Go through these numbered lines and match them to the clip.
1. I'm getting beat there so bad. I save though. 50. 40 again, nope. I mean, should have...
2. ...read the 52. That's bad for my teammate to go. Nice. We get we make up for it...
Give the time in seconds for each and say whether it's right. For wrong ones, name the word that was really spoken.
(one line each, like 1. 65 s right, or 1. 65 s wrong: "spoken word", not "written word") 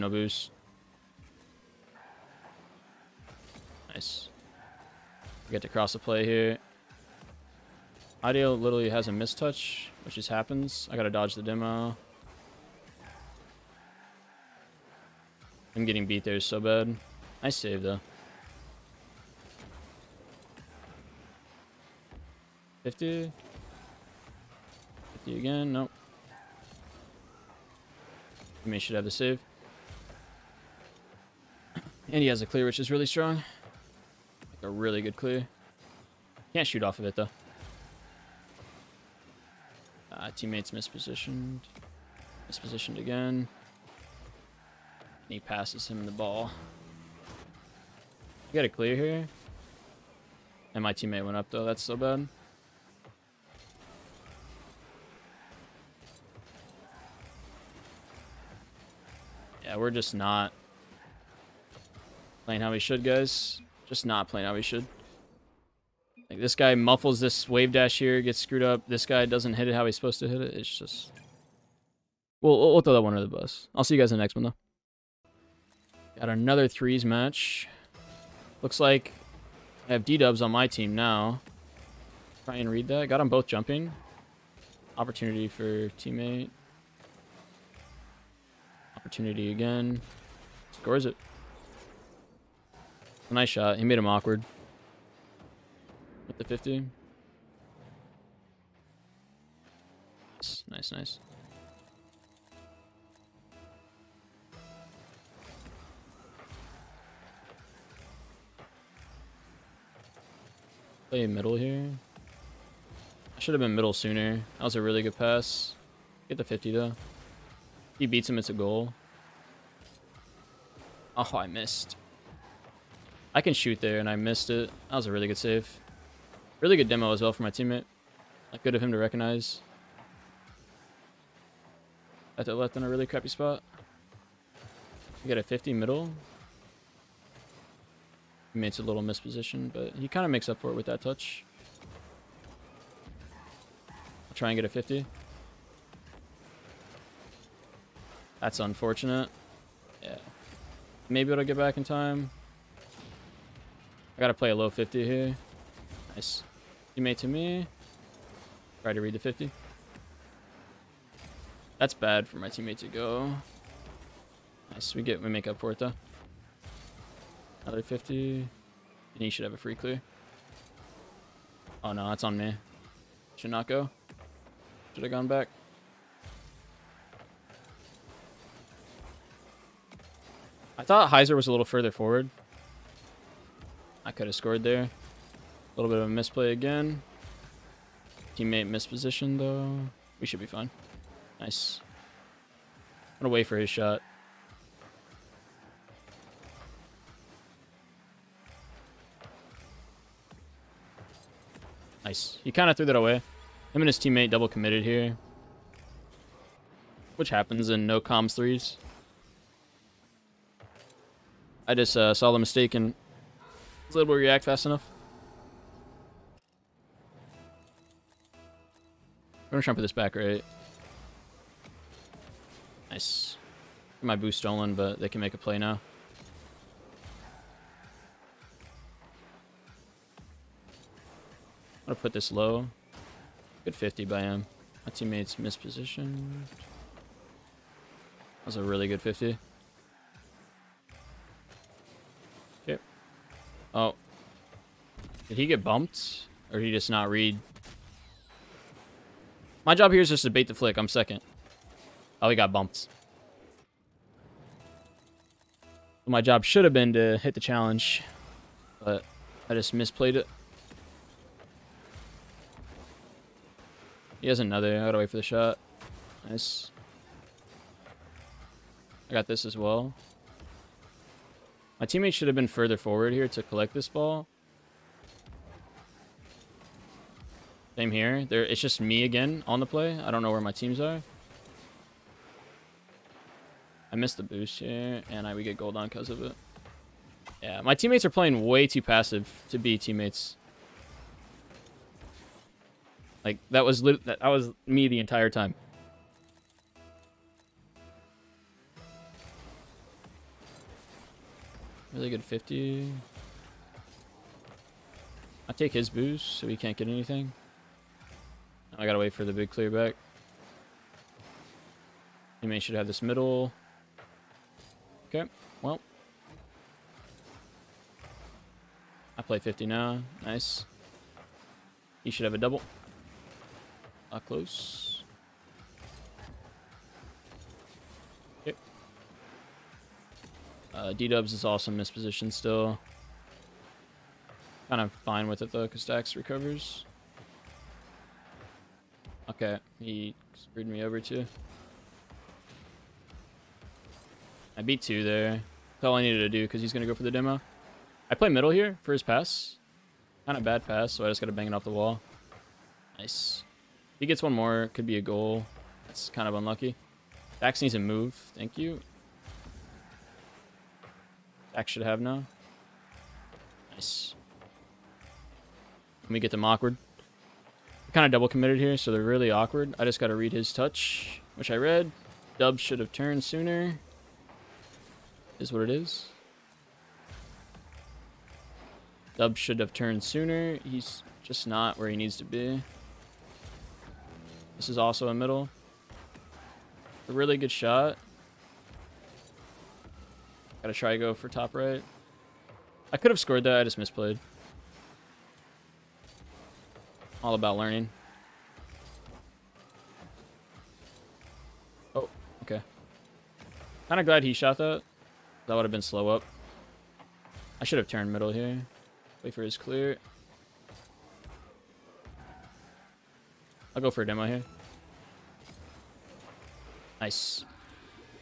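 1. 15 s wrong: "50", not "40"
2. 159 s wrong: "50", not "52".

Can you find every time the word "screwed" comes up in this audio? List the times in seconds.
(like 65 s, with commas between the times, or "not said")
68 s, 340 s.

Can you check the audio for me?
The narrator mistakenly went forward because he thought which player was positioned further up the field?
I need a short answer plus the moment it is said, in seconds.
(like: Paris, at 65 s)
Heiser, at 181 s.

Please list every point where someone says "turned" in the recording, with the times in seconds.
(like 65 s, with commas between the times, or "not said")
372 s, 379 s, 407 s.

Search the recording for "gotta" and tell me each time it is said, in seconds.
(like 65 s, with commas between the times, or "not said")
10 s, 154 s, 264 s, 308 s, 390 s.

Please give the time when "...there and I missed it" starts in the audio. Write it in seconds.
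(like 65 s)
123 s.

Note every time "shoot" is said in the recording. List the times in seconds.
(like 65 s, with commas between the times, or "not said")
36 s, 123 s.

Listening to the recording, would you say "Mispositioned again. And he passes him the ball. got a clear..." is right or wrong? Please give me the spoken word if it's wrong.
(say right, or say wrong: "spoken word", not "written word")
right.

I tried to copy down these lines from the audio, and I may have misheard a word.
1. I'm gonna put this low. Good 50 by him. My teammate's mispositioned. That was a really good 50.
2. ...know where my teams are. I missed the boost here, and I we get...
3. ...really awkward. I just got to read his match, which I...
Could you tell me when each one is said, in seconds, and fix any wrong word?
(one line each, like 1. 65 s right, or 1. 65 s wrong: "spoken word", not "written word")
1. 231 s right
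2. 280 s right
3. 369 s wrong: "touch", not "match".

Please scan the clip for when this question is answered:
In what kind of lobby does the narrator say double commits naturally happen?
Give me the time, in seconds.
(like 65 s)
207 s.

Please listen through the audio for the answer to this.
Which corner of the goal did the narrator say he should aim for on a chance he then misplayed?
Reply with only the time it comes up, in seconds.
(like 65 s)
391 s.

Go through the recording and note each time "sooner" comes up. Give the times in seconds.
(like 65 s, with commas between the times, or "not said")
113 s, 373 s, 380 s.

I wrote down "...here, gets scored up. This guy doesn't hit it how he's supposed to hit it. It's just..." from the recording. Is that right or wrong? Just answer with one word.
wrong.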